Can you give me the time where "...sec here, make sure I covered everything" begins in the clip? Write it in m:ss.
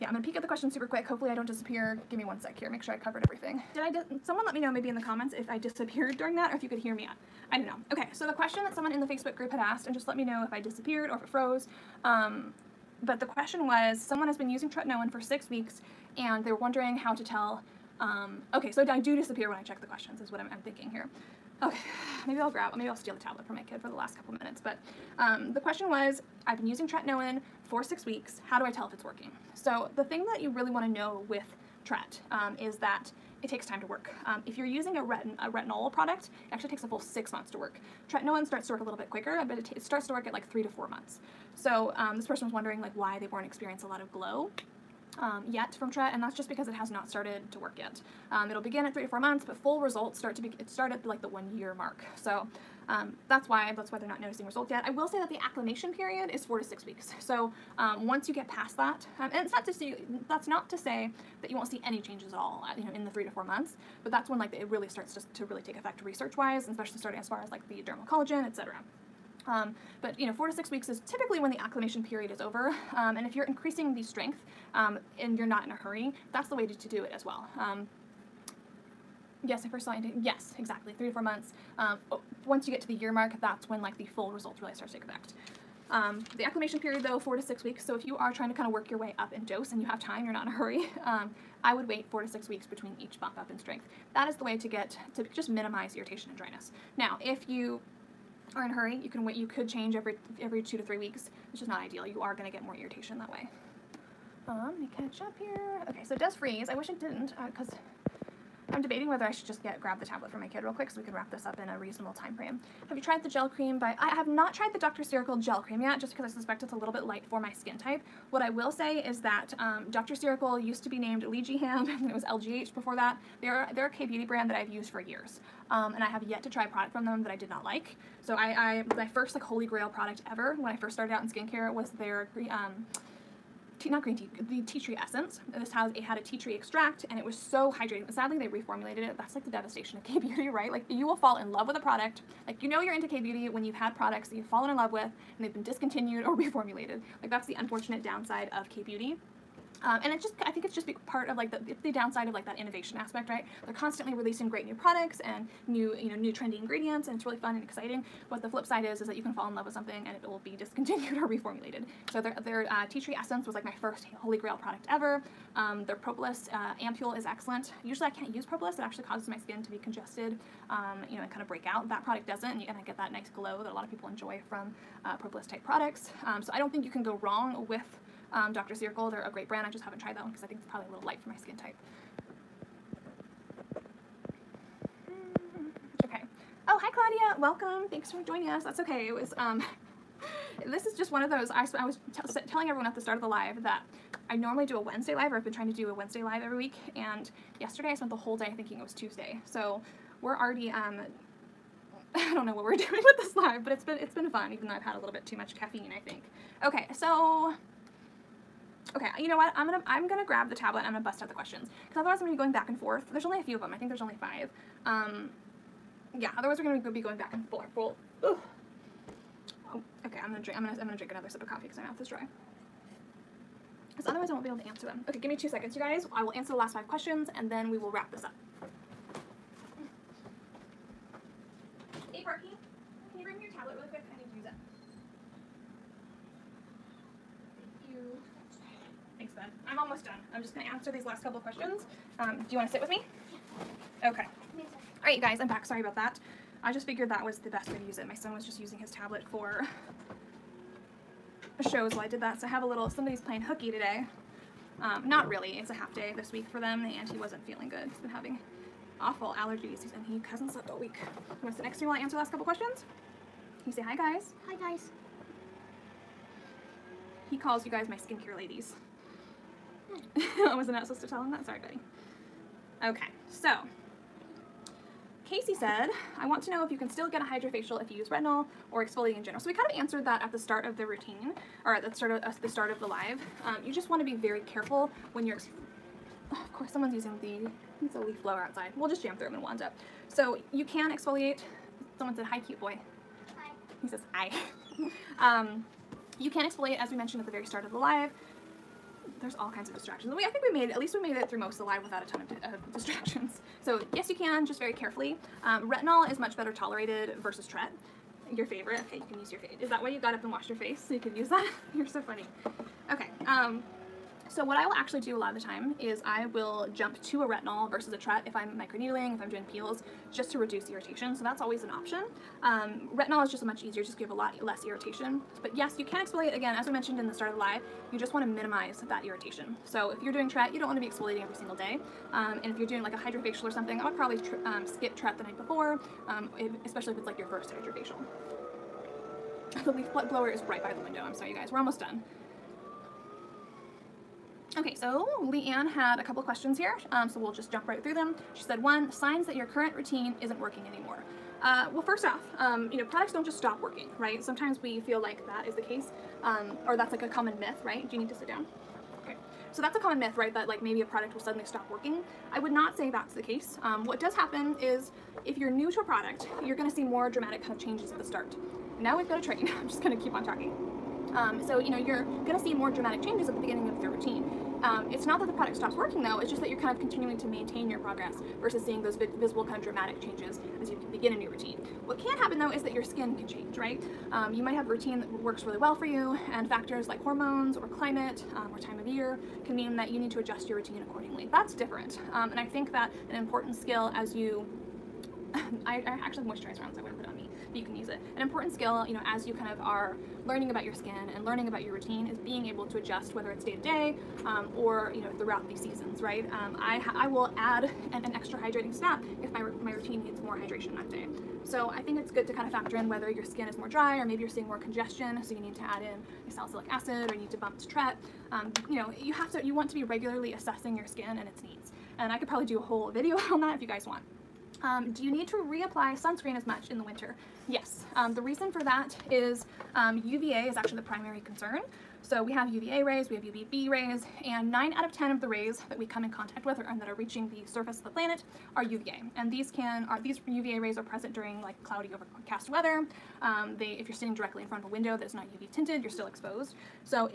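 0:02.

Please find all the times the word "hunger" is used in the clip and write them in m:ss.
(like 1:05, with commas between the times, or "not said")
not said.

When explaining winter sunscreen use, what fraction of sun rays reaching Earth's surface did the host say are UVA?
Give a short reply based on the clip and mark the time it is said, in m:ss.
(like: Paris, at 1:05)
9 out of 10, at 7:14.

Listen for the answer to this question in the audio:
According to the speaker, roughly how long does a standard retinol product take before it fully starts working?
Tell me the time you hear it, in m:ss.
0:36.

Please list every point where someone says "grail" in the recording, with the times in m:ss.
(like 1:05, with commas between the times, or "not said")
2:09, 2:44.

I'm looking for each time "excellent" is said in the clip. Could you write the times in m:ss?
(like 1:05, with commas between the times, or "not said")
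2:47.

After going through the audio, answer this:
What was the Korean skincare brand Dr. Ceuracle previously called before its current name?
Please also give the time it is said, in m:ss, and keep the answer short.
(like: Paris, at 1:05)
Leegeehaam, at 2:01.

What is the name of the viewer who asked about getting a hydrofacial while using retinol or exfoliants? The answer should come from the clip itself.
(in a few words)
Casey.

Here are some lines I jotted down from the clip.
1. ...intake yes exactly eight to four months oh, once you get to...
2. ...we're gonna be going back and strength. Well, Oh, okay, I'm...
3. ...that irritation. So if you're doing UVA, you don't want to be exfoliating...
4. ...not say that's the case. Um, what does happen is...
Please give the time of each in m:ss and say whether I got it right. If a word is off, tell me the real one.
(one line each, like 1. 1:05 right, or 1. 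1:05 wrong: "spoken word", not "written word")
1. 1:19 wrong: "three", not "eight"
2. 3:36 wrong: "forth", not "strength"
3. 5:28 wrong: "TRET", not "UVA"
4. 6:02 right.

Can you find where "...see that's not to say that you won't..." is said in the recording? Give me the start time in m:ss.
0:59.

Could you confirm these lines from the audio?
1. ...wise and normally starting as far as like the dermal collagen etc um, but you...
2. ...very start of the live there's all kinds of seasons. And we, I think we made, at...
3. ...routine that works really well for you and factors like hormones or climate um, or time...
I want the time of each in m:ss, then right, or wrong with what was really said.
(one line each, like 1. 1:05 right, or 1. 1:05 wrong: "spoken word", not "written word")
1. 1:06 wrong: "especially", not "normally"
2. 4:57 wrong: "distractions", not "seasons"
3. 6:24 right.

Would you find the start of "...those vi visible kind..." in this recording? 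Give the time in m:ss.
6:18.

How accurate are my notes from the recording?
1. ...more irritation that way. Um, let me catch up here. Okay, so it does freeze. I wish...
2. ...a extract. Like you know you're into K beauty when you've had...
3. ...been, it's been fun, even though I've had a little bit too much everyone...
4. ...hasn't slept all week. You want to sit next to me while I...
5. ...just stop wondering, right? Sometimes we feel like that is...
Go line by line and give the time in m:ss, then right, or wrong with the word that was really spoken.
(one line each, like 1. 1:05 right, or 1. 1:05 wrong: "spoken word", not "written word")
1. 1:42 right
2. 2:21 wrong: "product", not "extract"
3. 3:23 wrong: "caffeine", not "everyone"
4. 4:20 right
5. 5:53 wrong: "working", not "wondering".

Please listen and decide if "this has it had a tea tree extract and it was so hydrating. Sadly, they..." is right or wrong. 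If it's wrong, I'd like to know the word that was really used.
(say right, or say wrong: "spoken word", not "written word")
right.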